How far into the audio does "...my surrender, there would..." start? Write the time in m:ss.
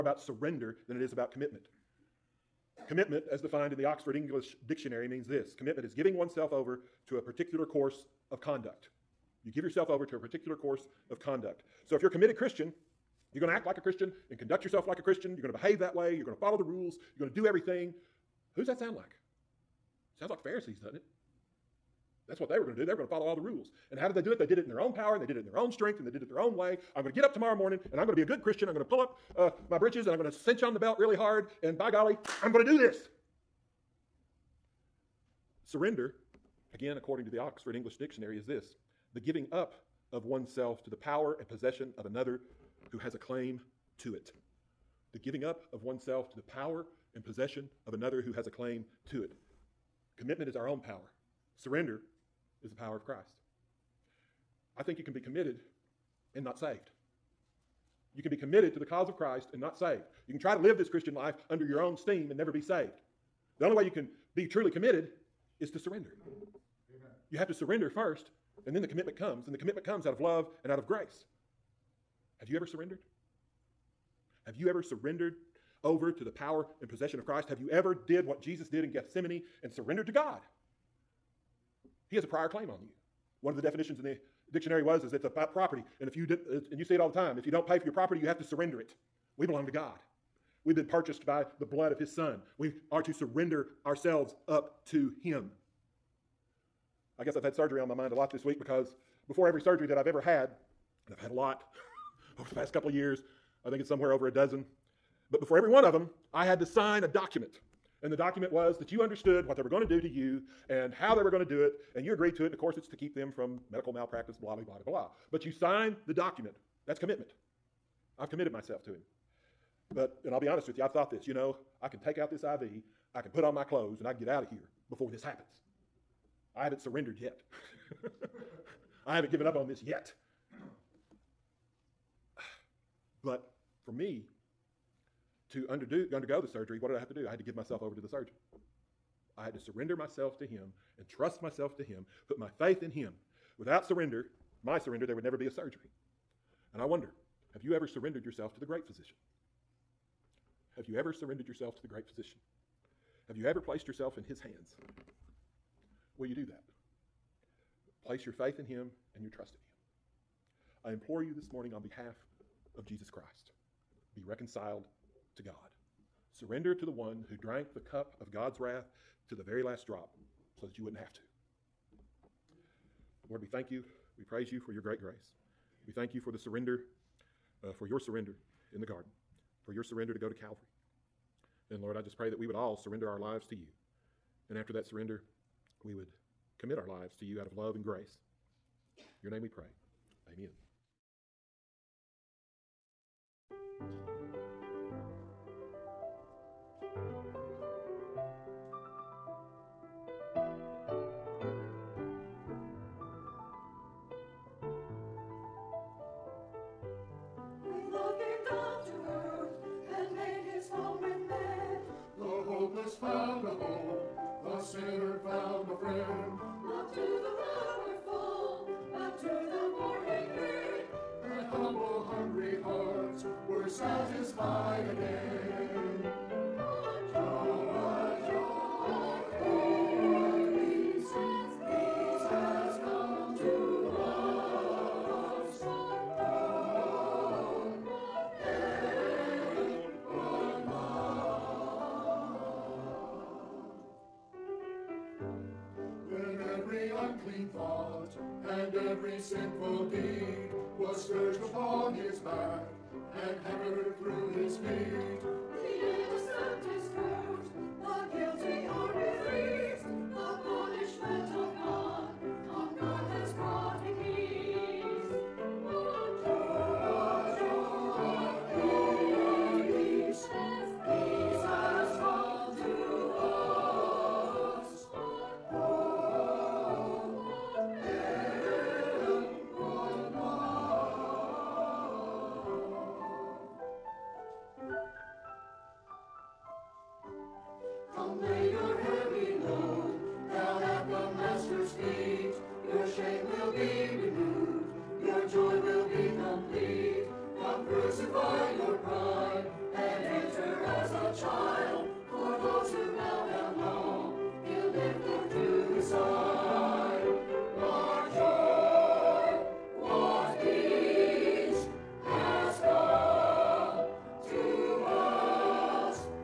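2:24.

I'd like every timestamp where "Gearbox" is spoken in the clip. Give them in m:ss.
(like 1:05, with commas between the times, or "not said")
not said.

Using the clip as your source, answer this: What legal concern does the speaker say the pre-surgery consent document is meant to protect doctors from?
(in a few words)
medical malpractice.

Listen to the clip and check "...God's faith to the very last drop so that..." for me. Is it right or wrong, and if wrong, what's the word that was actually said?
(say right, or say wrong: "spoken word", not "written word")
wrong: "wrath", not "faith".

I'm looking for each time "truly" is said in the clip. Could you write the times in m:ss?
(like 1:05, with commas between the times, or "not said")
1:04.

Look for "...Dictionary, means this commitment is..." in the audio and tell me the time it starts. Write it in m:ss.
0:04.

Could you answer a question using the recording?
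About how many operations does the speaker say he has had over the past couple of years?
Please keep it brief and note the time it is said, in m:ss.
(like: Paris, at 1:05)
over a dozen, at 1:43.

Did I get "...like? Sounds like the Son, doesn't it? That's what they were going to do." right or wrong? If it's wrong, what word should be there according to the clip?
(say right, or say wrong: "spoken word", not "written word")
wrong: "Pharisees", not "Son".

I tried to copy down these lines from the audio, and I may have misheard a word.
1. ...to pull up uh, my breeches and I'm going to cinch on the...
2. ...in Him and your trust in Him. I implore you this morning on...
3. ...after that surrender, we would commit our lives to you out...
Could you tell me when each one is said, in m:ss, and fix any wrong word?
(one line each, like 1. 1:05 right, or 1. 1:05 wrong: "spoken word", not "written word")
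1. 0:28 right
2. 2:38 right
3. 3:04 right.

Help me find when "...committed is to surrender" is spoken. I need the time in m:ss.
1:04.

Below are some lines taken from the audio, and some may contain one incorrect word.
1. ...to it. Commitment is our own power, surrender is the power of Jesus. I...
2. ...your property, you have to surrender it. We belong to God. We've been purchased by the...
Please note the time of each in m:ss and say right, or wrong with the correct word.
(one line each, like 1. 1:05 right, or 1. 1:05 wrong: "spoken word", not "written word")
1. 0:49 wrong: "Christ", not "Jesus"
2. 1:27 right.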